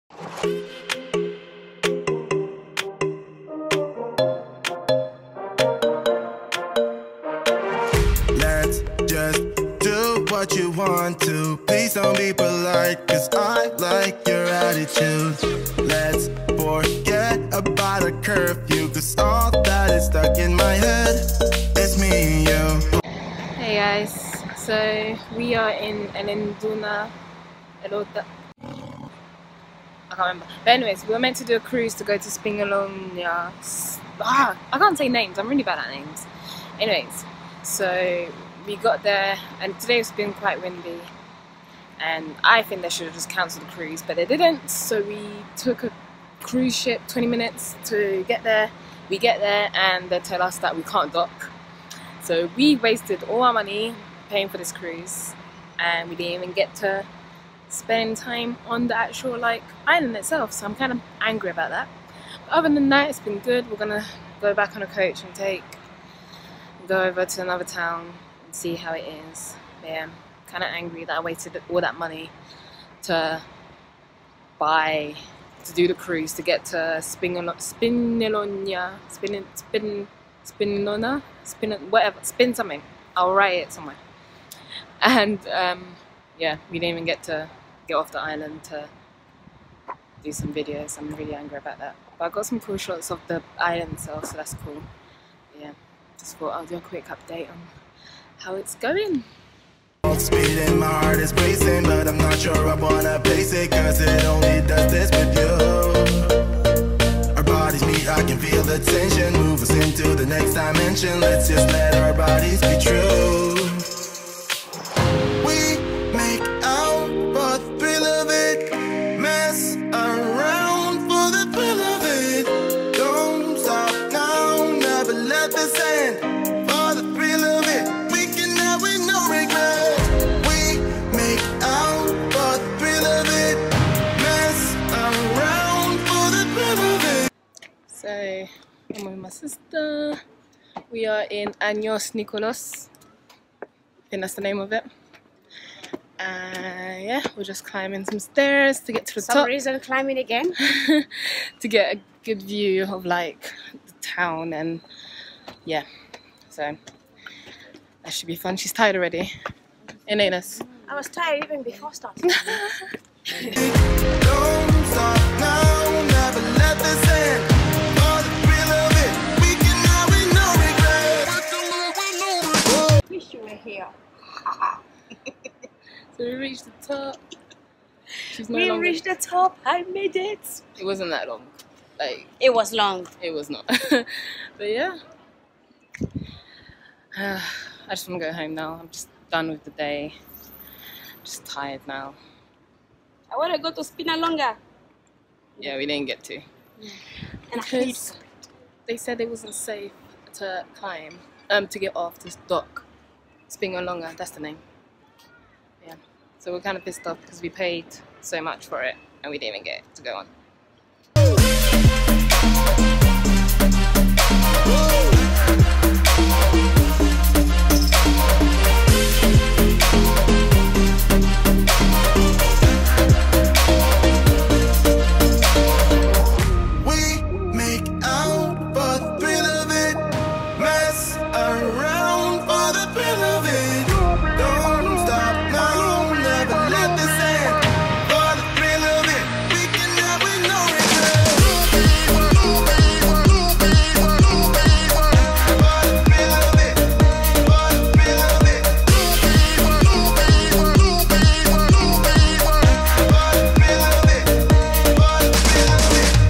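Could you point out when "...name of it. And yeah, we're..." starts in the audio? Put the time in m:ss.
2:24.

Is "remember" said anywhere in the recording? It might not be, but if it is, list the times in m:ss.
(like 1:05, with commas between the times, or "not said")
0:30.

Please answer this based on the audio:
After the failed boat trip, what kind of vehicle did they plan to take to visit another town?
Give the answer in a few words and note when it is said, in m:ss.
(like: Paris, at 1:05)
Coach, at 1:04.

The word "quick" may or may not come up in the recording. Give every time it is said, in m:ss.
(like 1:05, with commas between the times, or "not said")
1:36.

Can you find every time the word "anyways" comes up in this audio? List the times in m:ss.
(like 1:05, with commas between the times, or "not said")
0:30, 0:36.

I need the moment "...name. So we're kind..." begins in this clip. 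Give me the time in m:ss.
3:24.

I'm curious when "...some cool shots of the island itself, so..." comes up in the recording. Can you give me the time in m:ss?
1:32.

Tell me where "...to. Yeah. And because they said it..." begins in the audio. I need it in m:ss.
3:16.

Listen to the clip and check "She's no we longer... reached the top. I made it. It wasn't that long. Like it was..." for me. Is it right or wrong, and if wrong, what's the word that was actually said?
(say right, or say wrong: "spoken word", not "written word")
right.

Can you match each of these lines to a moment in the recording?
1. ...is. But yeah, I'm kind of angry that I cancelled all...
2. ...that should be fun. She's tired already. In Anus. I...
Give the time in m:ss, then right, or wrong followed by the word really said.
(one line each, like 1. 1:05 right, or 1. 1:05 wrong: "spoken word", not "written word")
1. 1:09 wrong: "wasted", not "cancelled"
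2. 2:38 right.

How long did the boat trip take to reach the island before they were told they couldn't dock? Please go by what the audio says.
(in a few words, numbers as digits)
20 minutes.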